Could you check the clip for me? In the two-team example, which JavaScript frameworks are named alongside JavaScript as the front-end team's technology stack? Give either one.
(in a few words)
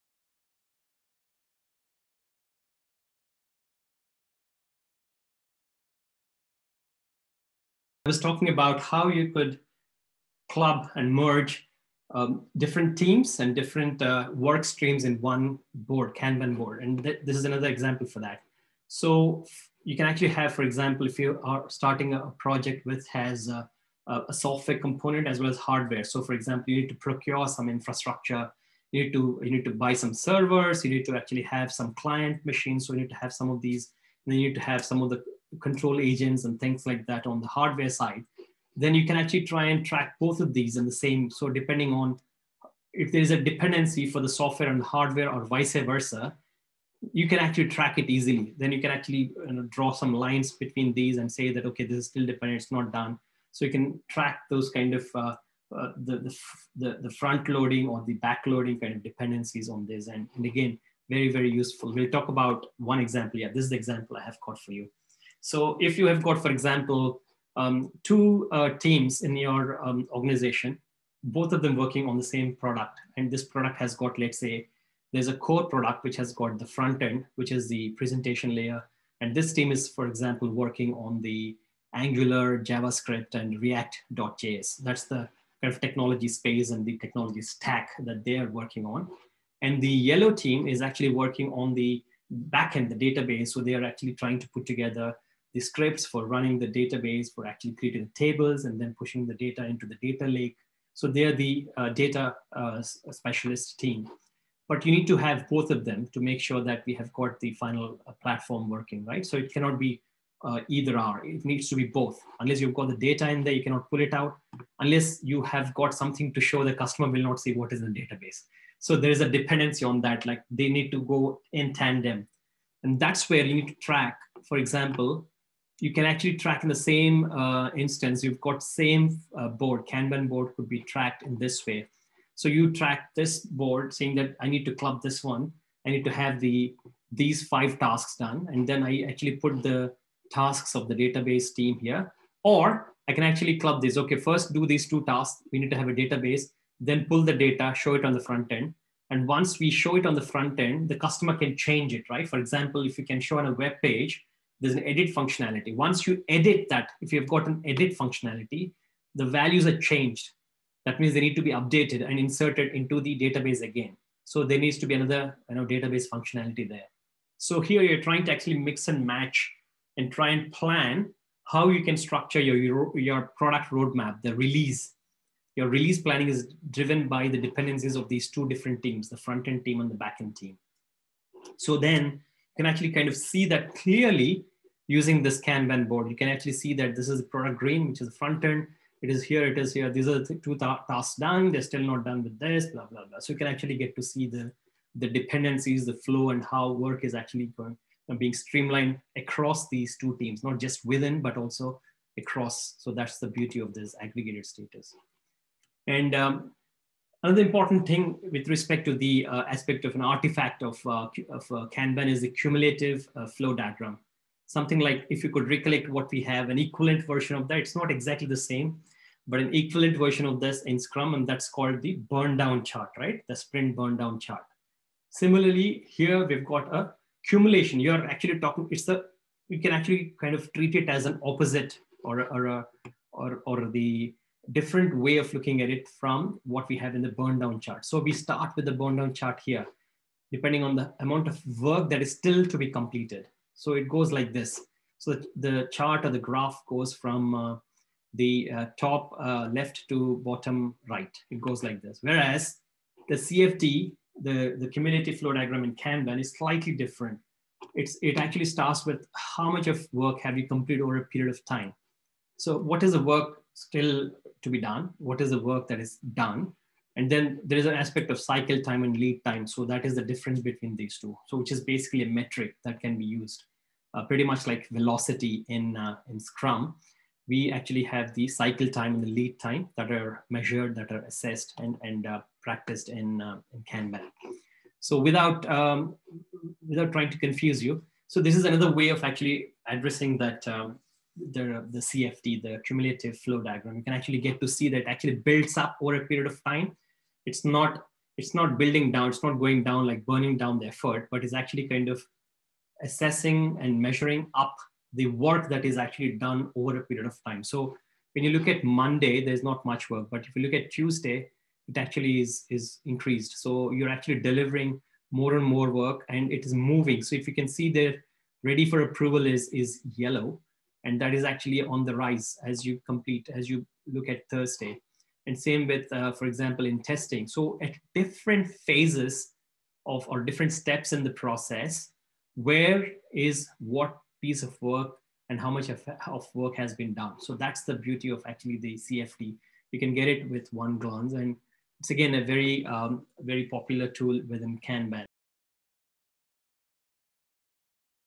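Angular.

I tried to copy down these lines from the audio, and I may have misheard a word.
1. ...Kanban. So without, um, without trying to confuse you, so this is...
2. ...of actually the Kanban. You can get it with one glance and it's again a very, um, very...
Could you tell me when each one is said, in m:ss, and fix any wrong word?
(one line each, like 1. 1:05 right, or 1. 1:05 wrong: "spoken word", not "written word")
1. 4:43 right
2. 5:38 wrong: "CFD", not "Kanban".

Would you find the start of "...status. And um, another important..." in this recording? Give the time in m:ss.
3:24.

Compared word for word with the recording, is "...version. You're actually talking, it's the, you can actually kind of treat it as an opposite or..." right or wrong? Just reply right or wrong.
wrong.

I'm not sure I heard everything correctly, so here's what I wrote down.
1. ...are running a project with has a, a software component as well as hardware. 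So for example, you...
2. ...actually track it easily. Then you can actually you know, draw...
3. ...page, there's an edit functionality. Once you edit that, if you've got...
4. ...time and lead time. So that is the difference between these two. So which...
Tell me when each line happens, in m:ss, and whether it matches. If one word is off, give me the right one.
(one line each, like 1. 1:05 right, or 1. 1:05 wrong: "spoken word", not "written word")
1. 0:21 wrong: "starting", not "running"
2. 0:47 right
3. 2:33 right
4. 4:28 right.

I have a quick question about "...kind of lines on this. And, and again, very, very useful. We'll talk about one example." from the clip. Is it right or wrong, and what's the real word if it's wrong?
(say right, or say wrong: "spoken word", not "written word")
wrong: "dependencies", not "lines".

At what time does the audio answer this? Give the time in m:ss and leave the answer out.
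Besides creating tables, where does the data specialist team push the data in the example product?
1:40.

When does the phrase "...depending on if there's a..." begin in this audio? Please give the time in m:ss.
0:41.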